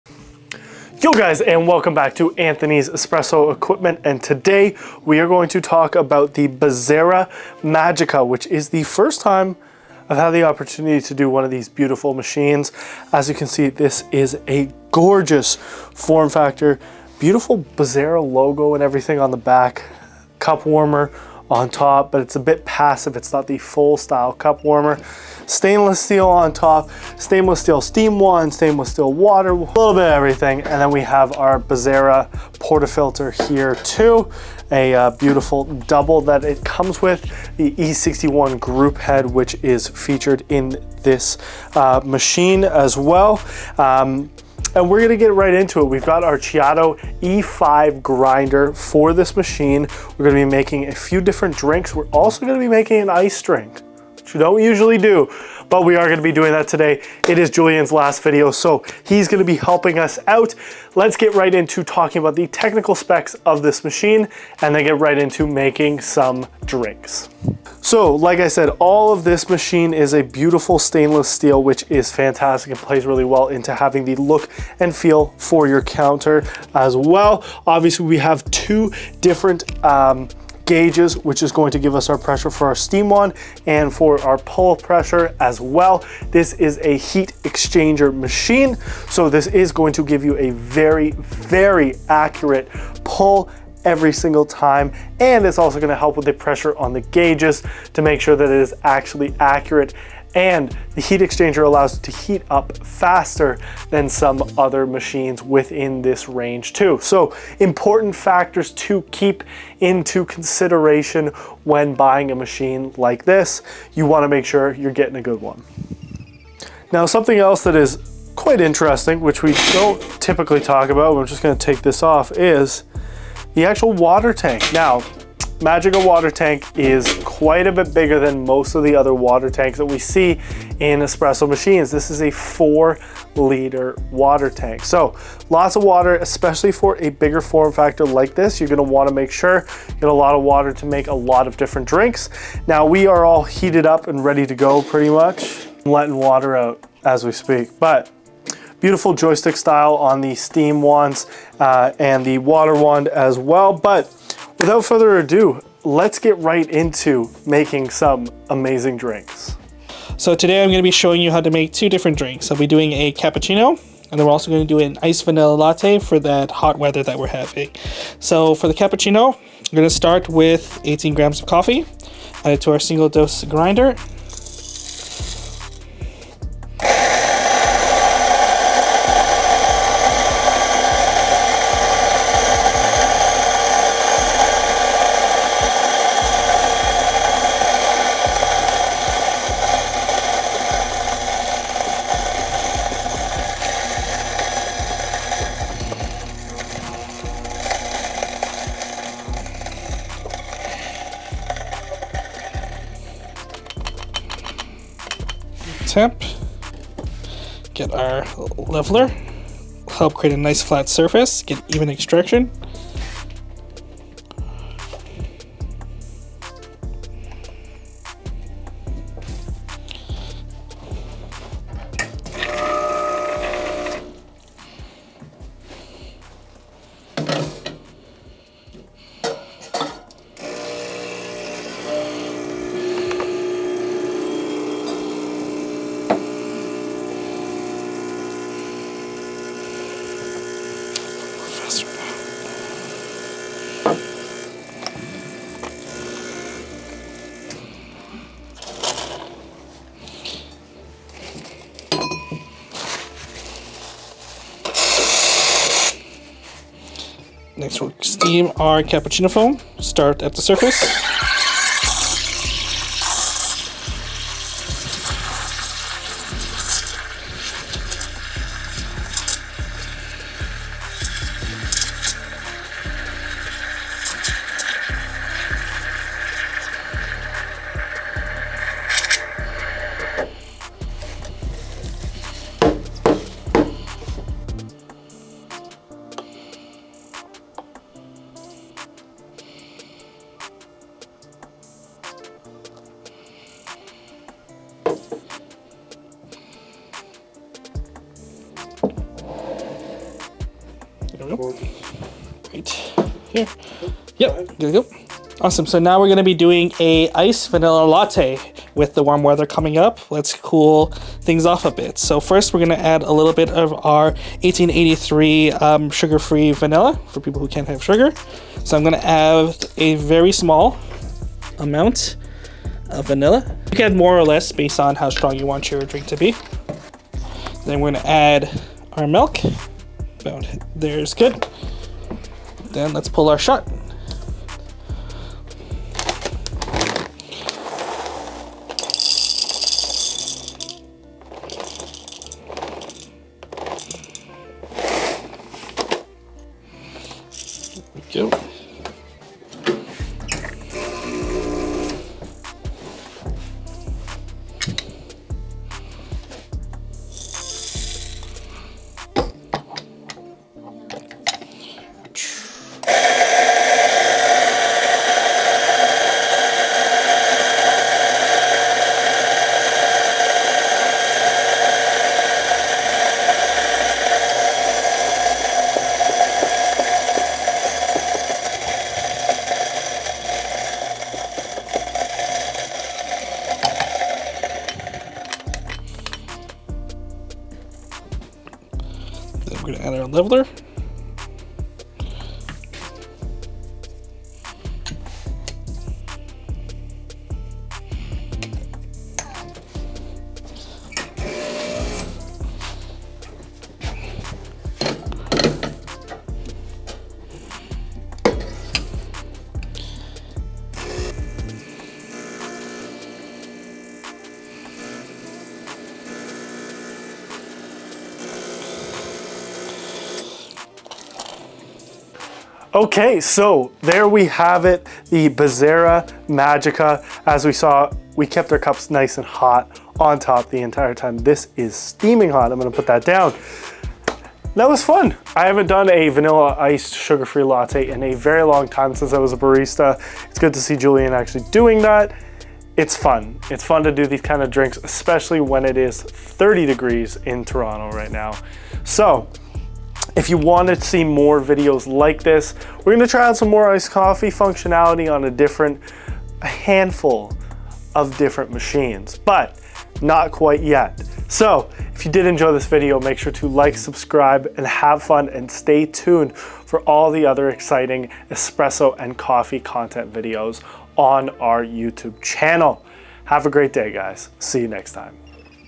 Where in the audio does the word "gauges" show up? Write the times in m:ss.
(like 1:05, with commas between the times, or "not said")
1:20, 1:37.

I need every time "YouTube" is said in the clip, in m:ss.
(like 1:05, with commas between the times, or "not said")
7:51.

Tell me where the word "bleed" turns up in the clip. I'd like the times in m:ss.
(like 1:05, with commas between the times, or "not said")
not said.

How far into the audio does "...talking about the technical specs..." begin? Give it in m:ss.
1:01.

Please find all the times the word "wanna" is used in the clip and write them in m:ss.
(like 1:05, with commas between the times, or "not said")
1:54, 2:18.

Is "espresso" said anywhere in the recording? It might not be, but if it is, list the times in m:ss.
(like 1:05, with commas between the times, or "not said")
0:02, 2:11, 7:48.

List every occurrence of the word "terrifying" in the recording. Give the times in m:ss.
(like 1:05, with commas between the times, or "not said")
not said.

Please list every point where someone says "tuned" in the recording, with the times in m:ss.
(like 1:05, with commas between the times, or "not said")
7:45.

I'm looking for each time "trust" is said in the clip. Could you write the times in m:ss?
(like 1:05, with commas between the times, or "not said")
not said.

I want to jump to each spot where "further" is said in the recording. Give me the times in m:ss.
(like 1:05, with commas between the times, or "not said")
2:34.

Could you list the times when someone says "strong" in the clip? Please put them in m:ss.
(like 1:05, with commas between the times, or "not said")
5:25.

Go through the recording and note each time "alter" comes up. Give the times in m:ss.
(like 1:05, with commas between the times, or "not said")
not said.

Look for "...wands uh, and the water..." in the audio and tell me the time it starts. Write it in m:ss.
2:30.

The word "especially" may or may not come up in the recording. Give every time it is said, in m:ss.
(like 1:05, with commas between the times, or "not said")
2:16, 7:24.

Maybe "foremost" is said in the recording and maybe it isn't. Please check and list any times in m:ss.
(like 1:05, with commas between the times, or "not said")
not said.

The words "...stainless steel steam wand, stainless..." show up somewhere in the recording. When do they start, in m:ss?
0:27.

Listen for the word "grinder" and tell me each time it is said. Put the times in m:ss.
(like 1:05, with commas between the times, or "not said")
0:48, 2:53.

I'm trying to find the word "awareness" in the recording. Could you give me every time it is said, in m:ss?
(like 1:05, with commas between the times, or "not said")
not said.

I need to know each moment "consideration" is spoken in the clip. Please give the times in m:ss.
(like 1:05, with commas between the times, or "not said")
1:50.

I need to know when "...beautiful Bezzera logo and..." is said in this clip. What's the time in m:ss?
0:17.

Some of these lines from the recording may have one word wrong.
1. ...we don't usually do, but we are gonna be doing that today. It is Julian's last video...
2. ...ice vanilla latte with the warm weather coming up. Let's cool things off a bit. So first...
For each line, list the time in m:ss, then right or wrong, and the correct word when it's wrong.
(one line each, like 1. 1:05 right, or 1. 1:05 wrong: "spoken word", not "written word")
1. 0:54 right
2. 5:07 right.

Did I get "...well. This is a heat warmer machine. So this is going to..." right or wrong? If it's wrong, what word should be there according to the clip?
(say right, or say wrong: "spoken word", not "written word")
wrong: "exchanger", not "warmer".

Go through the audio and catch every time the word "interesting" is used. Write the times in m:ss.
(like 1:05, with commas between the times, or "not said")
1:58.